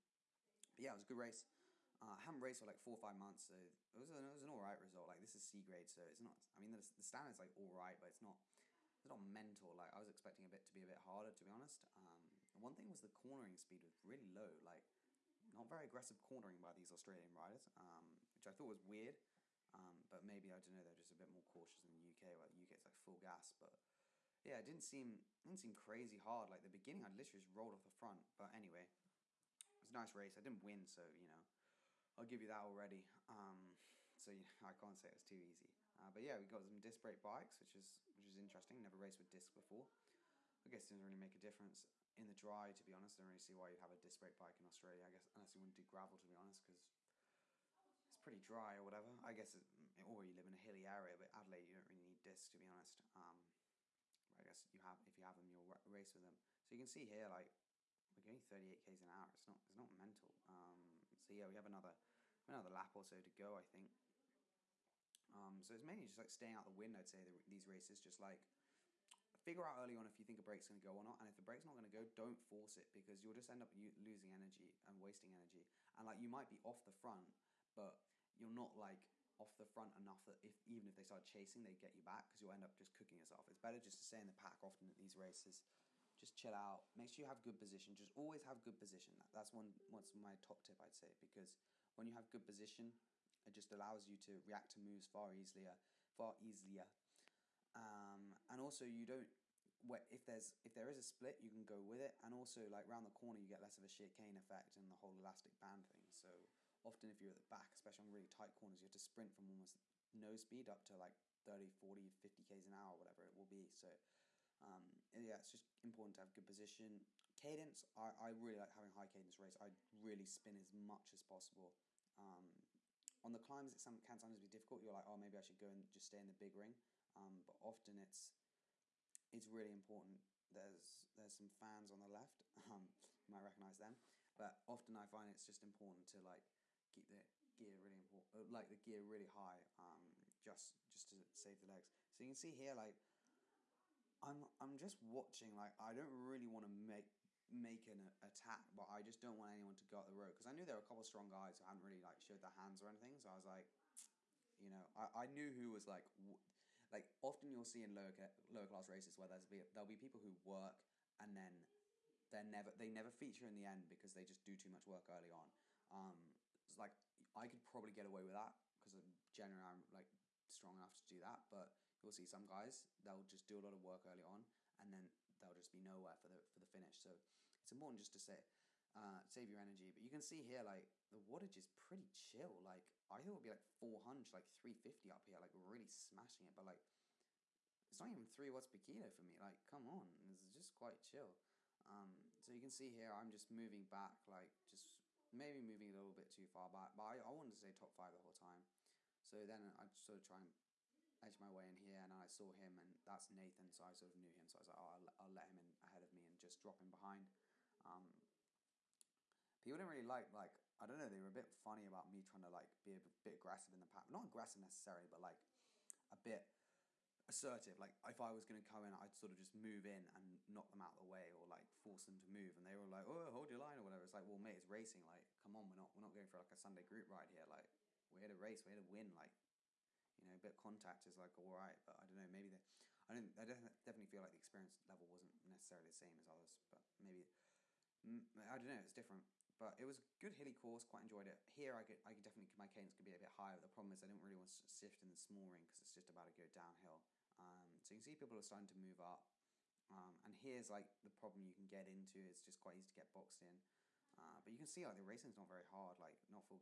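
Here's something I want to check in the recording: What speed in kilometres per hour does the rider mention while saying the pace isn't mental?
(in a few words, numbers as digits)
38.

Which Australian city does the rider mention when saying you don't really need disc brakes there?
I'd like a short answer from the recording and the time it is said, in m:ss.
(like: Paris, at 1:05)
Adelaide, at 0:51.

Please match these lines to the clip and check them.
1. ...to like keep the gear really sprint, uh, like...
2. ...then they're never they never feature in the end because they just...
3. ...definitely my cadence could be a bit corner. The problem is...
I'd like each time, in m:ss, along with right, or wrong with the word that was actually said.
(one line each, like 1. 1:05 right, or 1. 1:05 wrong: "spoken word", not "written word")
1. 2:16 wrong: "important", not "sprint"
2. 2:41 right
3. 4:02 wrong: "higher", not "corner".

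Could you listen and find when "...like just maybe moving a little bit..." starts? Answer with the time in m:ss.
3:14.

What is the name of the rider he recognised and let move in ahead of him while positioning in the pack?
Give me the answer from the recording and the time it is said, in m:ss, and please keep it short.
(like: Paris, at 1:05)
Nathan, at 3:23.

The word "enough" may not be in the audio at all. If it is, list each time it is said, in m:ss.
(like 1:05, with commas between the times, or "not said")
1:19, 2:50.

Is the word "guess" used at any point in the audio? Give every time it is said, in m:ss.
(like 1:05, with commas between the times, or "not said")
0:40, 0:45, 0:49, 0:54.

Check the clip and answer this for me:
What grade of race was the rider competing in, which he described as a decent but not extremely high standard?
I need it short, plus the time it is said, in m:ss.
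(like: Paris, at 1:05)
C grade, at 0:05.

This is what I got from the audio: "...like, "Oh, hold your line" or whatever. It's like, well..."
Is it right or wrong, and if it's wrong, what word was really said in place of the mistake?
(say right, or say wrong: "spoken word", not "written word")
right.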